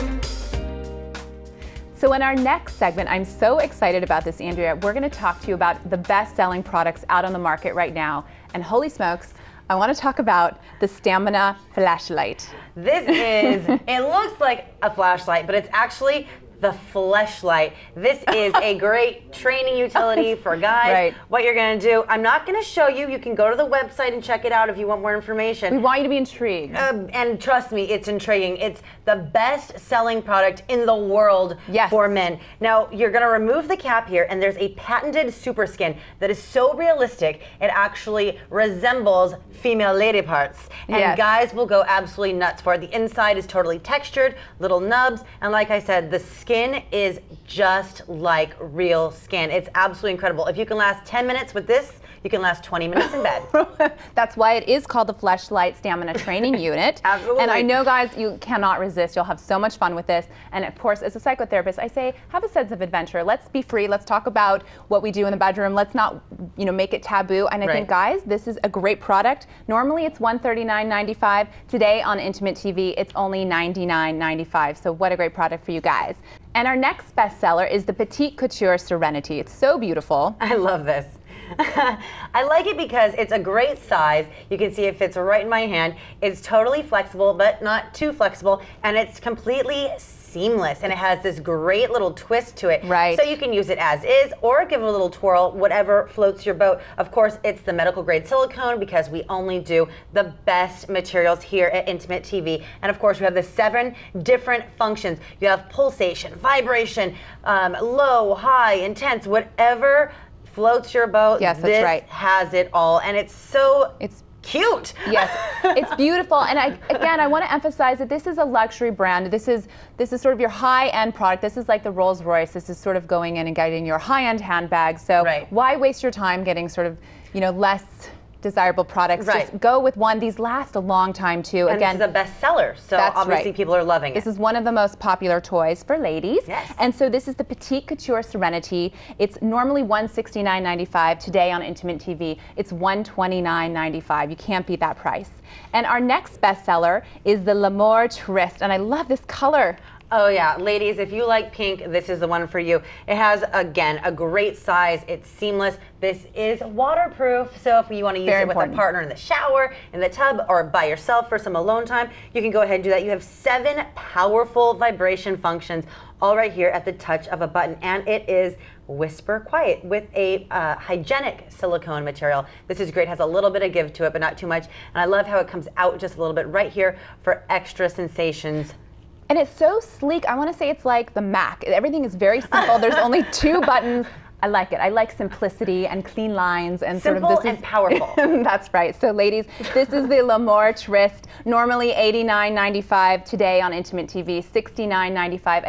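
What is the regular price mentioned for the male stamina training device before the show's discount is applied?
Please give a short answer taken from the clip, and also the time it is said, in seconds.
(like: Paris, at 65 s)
$139.95, at 70 s.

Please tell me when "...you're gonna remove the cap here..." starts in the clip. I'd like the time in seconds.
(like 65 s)
32 s.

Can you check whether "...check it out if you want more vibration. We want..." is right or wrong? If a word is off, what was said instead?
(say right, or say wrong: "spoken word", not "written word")
wrong: "information", not "vibration".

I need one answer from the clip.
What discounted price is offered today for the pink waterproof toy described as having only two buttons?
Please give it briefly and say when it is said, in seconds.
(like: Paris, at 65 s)
$69.95, at 194 s.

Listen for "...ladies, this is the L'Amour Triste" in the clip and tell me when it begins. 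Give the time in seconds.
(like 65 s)
189 s.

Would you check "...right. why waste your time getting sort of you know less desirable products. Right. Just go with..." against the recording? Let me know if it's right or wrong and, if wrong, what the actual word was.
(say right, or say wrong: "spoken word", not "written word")
right.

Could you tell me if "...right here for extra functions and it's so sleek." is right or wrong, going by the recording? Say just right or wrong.
wrong.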